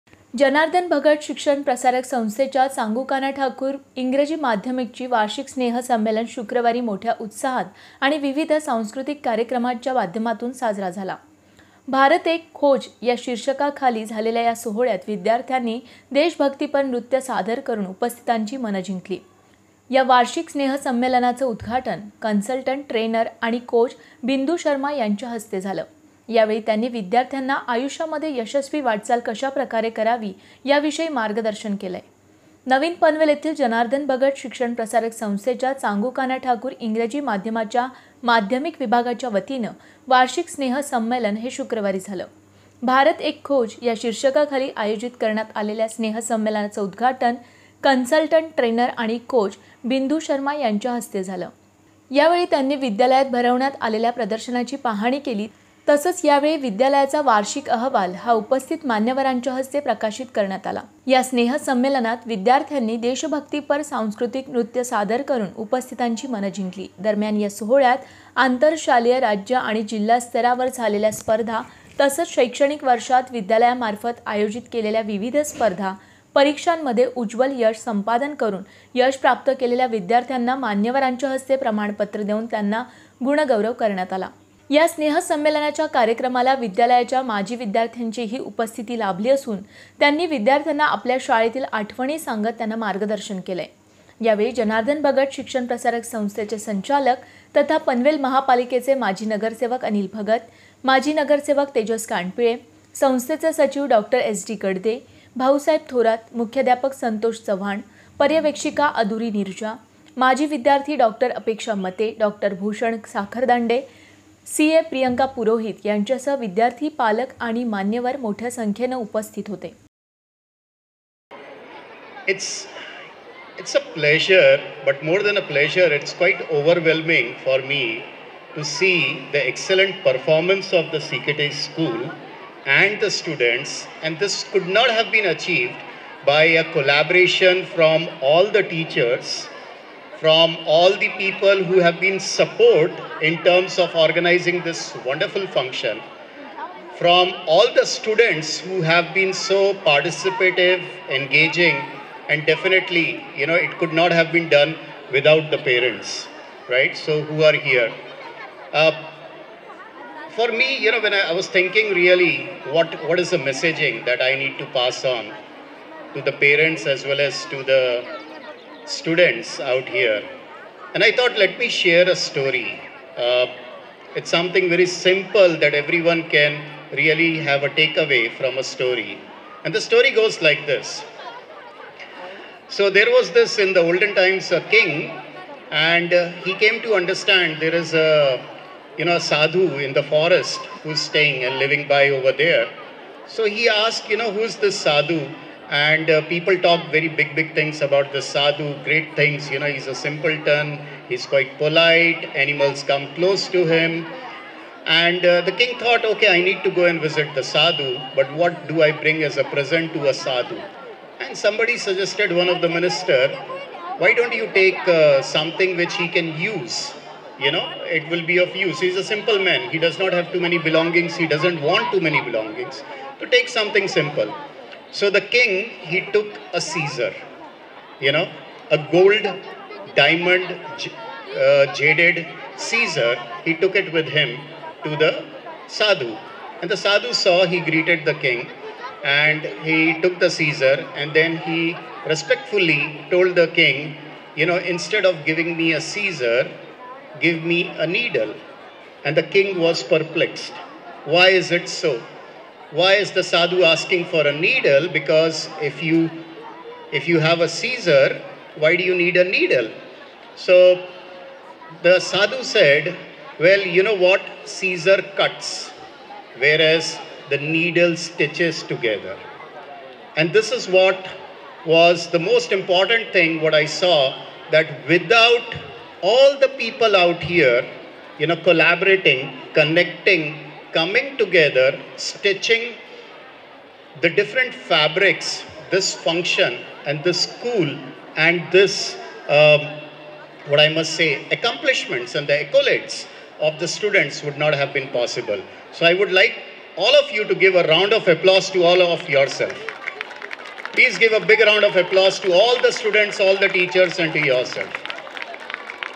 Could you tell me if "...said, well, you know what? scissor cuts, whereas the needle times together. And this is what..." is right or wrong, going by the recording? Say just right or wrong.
wrong.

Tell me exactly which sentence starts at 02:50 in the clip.
And I thought, let me share a story.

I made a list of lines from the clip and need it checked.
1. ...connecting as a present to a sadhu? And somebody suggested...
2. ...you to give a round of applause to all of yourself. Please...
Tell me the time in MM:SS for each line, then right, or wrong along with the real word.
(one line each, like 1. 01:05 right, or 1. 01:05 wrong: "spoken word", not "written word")
1. 03:28 wrong: "bring", not "connecting"
2. 04:57 right.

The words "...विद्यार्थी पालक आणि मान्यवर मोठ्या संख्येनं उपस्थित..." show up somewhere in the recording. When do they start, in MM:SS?
01:56.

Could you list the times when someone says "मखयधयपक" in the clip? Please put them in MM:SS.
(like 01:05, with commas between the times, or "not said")
01:46.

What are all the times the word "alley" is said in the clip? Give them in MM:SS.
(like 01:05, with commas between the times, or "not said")
not said.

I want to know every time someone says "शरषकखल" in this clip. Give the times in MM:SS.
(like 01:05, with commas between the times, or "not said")
00:13, 00:44.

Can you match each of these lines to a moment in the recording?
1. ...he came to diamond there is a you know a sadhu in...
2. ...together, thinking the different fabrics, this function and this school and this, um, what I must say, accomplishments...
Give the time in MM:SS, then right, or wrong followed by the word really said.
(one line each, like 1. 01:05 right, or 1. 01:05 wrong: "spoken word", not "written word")
1. 03:06 wrong: "understand", not "diamond"
2. 04:41 wrong: "stitching", not "thinking".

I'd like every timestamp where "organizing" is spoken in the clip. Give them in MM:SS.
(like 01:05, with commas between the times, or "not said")
02:23.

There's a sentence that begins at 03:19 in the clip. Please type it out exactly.
You know, he's a simpleton, he's quite polite, animals come close to him.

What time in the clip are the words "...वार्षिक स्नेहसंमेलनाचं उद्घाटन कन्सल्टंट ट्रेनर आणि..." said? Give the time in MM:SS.
00:20.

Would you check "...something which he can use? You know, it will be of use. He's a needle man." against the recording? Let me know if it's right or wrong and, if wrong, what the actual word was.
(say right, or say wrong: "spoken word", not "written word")
wrong: "simple", not "needle".